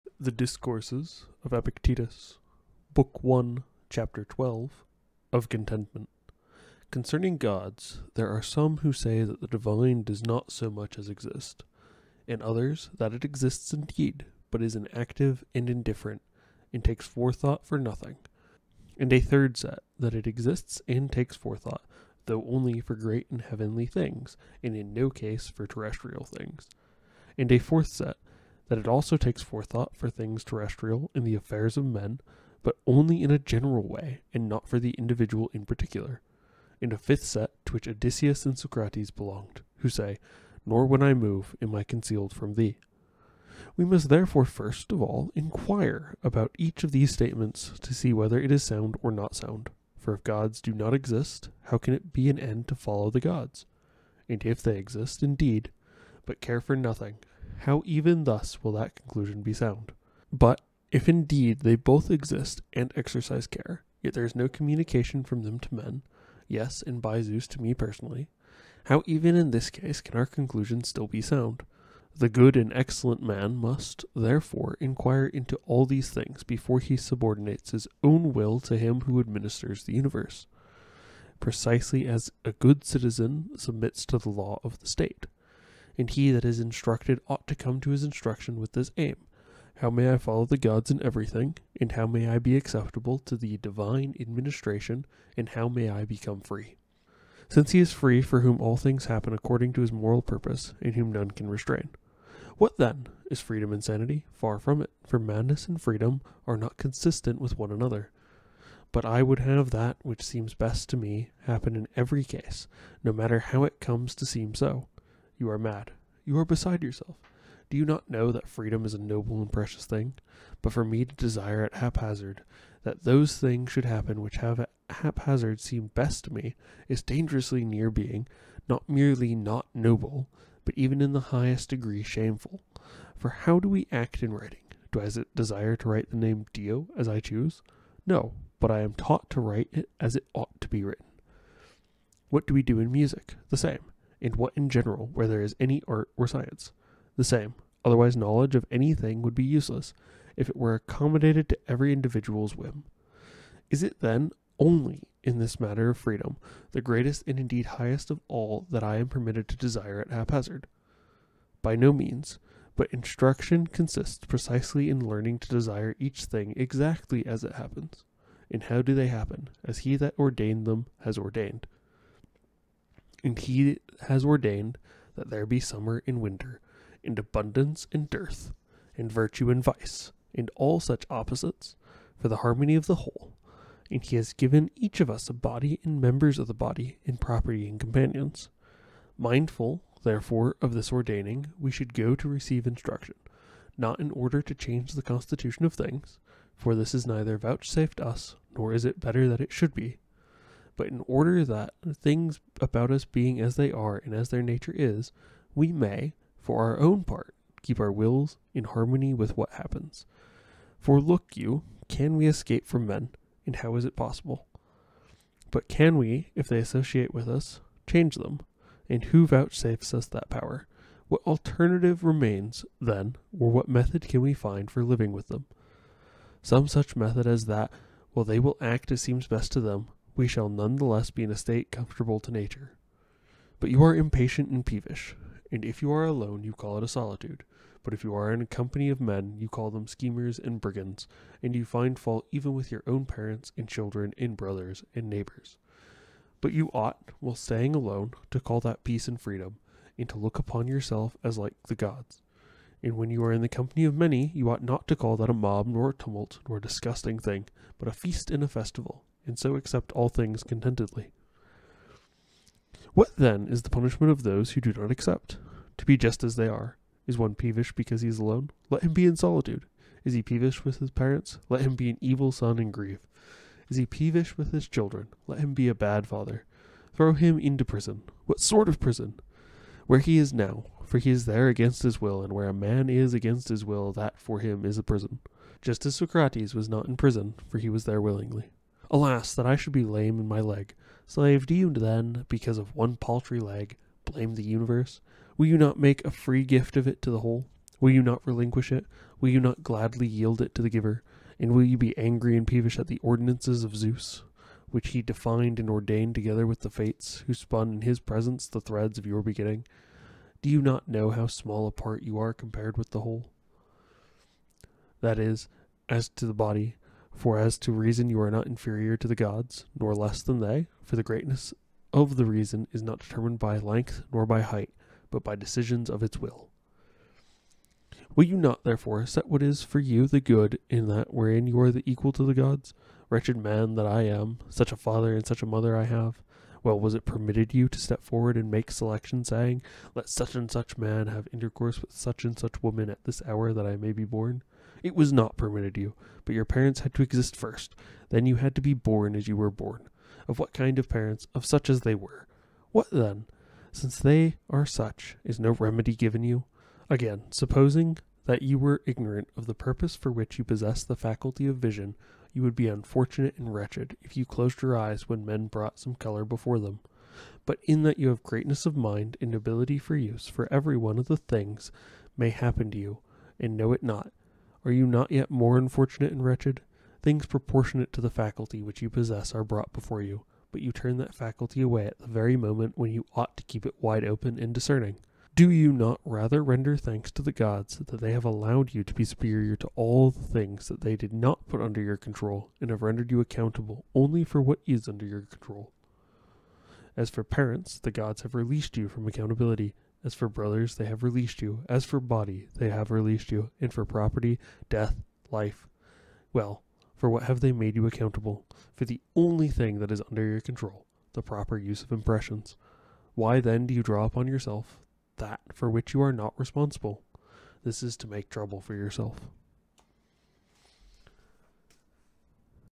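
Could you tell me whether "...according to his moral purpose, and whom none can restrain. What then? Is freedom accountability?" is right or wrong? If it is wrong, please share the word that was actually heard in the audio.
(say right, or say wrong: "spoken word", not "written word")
wrong: "insanity", not "accountability".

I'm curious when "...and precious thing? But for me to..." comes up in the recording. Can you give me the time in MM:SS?
01:59.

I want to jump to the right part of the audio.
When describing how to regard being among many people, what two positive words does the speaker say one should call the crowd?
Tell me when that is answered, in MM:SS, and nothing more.
04:17.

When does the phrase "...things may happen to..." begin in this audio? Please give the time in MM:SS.
06:11.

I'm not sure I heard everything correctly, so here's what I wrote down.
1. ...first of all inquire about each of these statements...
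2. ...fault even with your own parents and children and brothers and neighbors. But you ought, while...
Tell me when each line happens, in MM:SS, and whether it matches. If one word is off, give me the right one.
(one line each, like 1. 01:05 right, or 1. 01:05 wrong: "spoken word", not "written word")
1. 00:44 right
2. 04:01 right.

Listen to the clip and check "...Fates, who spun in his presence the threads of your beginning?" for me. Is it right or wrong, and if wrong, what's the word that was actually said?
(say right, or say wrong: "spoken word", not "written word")
right.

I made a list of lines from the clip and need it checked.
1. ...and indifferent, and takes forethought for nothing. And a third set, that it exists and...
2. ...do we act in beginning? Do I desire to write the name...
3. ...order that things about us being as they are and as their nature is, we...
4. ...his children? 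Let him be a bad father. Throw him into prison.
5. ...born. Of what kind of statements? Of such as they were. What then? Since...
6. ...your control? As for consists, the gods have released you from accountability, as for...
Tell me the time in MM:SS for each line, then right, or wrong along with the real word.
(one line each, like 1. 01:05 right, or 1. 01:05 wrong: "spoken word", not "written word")
1. 00:15 right
2. 02:13 wrong: "writing", not "beginning"
3. 03:21 right
4. 04:34 right
5. 05:49 wrong: "parents", not "statements"
6. 06:35 wrong: "parents", not "consists".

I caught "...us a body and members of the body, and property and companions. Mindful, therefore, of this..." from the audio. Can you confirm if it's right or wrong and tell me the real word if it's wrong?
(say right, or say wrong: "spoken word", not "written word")
right.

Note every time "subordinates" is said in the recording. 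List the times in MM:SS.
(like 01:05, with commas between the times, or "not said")
01:16.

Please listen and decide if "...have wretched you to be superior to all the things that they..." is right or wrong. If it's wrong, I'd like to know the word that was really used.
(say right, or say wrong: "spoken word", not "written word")
wrong: "allowed", not "wretched".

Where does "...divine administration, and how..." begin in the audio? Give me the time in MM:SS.
01:33.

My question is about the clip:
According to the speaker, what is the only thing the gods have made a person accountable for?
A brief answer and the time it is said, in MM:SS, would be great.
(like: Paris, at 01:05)
proper use of impressions, at 06:51.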